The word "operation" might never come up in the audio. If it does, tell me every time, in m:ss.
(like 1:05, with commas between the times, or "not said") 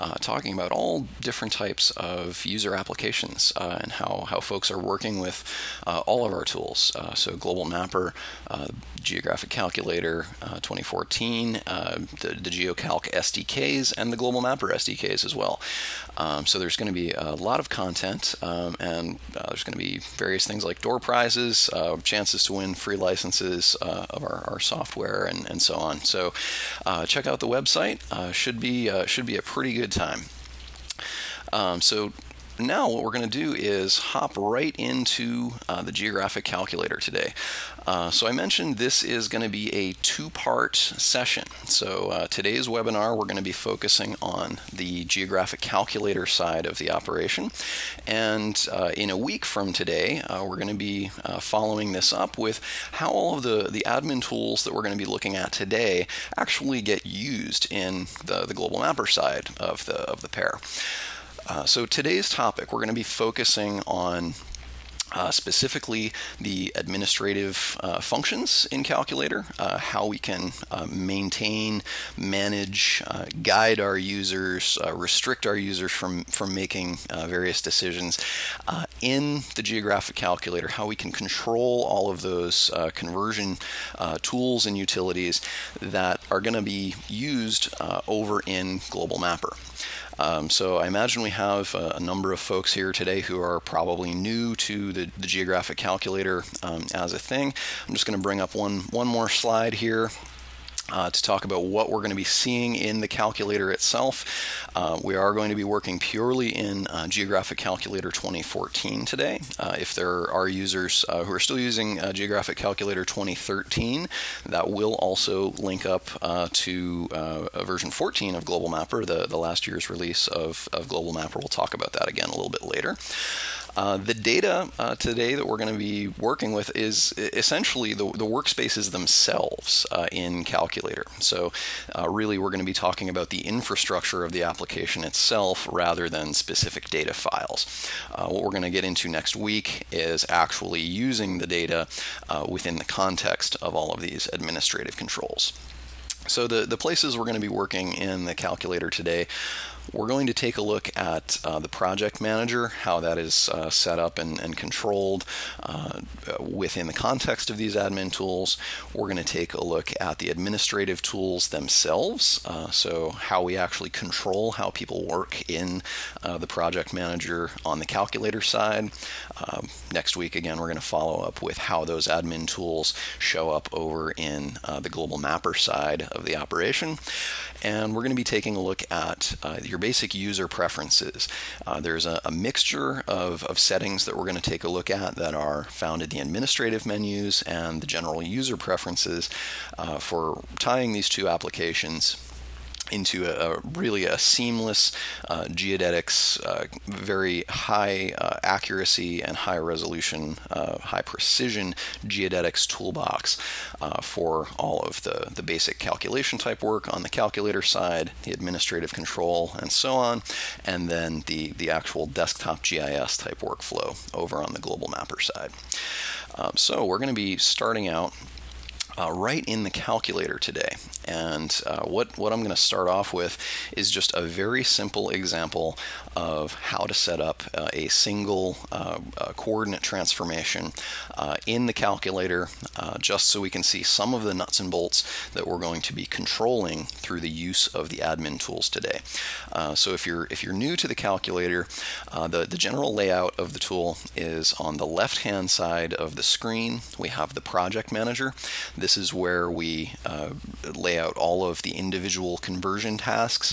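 0:46, 2:56.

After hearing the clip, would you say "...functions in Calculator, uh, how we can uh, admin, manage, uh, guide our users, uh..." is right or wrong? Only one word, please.
wrong.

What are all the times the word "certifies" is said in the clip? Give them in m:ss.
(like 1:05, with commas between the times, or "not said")
not said.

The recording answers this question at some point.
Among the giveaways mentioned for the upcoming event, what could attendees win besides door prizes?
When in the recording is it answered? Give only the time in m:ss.
0:22.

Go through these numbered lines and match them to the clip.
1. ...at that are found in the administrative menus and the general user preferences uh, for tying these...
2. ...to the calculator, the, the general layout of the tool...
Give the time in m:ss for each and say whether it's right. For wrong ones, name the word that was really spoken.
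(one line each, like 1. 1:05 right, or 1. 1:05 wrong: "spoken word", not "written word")
1. 3:04 right
2. 4:00 right.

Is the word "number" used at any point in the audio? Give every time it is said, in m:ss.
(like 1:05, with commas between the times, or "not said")
1:32.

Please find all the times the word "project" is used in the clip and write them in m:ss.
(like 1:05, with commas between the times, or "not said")
2:31, 2:46, 4:07.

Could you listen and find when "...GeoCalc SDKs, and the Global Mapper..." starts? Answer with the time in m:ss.
0:12.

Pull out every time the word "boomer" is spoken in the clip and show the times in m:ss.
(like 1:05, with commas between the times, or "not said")
not said.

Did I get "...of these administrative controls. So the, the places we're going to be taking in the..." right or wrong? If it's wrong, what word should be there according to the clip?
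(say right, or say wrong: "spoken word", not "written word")
wrong: "working", not "taking".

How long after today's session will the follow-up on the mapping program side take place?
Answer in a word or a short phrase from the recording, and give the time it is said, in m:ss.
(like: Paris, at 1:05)
a week, at 0:48.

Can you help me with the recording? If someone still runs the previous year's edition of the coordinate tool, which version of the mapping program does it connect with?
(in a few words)
version 14.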